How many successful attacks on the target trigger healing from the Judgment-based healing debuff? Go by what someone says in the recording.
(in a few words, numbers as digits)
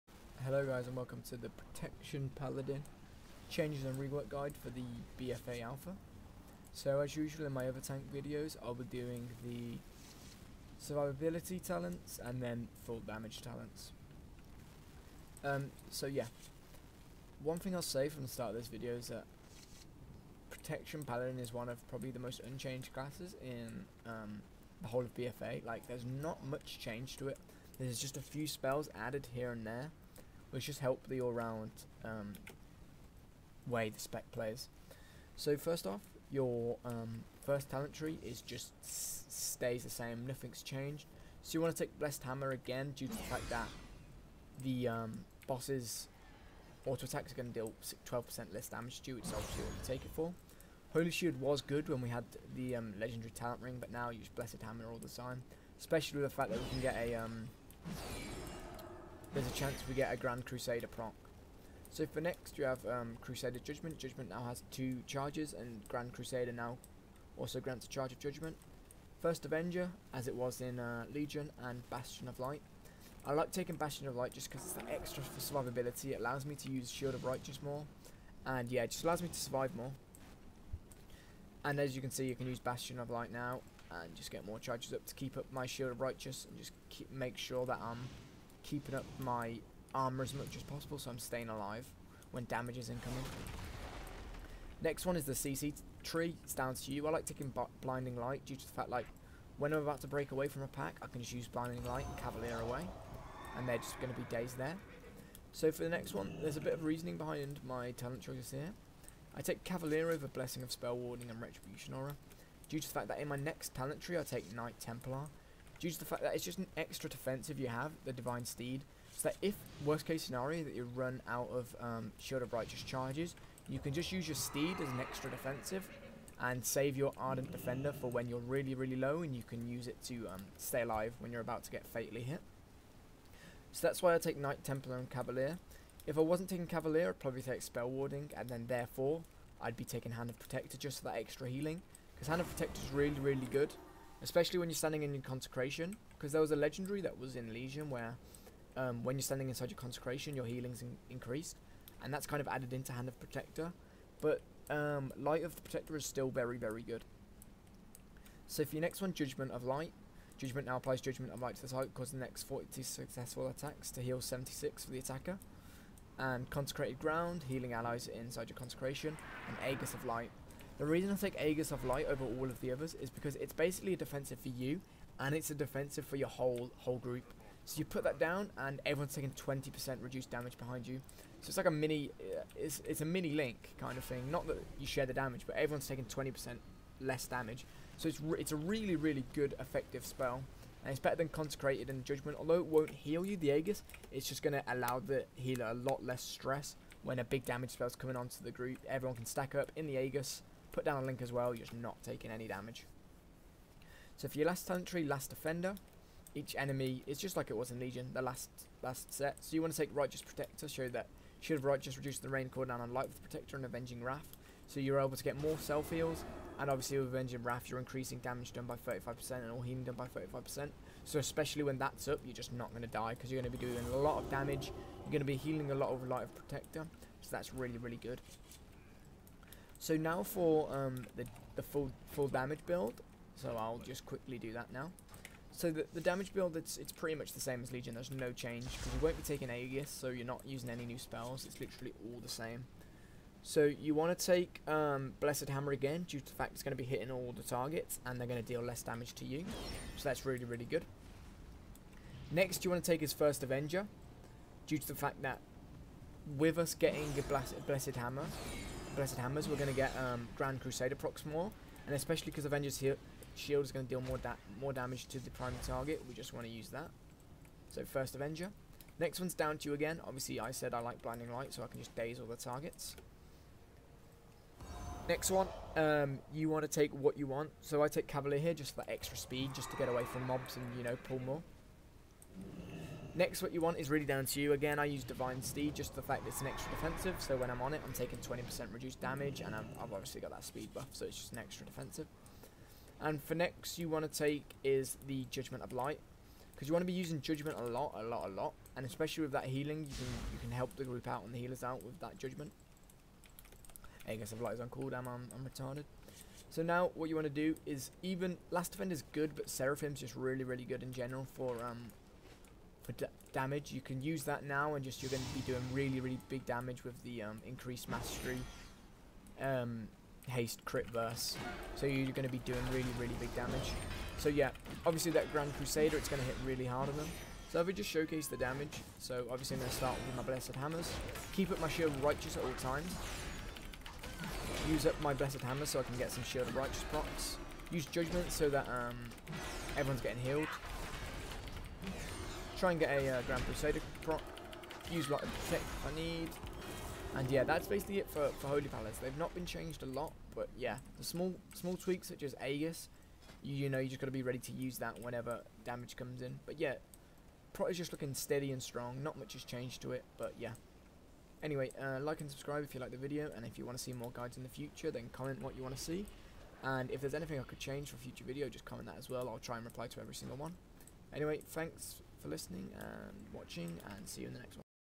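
40.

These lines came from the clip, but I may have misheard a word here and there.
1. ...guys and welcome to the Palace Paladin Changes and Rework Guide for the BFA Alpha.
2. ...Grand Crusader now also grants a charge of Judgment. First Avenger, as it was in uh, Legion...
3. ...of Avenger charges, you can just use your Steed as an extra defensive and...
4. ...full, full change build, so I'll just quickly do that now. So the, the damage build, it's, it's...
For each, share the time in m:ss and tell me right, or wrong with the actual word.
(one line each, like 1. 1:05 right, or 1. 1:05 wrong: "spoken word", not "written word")
1. 0:00 wrong: "Protection", not "Palace"
2. 1:05 right
3. 2:02 wrong: "Righteous", not "Avenger"
4. 3:51 wrong: "damage", not "change".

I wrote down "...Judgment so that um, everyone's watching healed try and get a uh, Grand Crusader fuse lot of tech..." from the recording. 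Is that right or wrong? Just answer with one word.
wrong.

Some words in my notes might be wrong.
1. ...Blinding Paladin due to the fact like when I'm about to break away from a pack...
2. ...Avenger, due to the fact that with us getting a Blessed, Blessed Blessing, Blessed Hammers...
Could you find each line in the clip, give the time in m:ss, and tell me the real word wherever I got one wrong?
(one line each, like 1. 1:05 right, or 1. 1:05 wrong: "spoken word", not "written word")
1. 1:37 wrong: "Light", not "Paladin"
2. 4:13 wrong: "Hammer", not "Blessing".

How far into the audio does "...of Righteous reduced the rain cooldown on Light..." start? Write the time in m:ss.
3:31.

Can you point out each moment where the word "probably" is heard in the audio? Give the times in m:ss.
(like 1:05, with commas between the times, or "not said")
0:21, 2:17.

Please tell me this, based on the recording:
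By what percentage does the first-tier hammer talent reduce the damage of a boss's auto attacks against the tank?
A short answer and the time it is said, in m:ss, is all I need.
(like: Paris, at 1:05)
12%, at 0:48.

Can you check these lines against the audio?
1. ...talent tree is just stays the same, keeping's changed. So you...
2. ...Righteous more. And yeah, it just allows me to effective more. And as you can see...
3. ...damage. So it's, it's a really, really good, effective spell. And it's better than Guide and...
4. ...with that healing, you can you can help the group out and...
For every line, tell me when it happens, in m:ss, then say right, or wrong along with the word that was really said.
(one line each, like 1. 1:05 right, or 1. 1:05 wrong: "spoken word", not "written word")
1. 0:37 wrong: "nothing", not "keeping"
2. 1:17 wrong: "survive", not "effective"
3. 3:07 wrong: "Consecrated", not "Guide"
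4. 4:59 right.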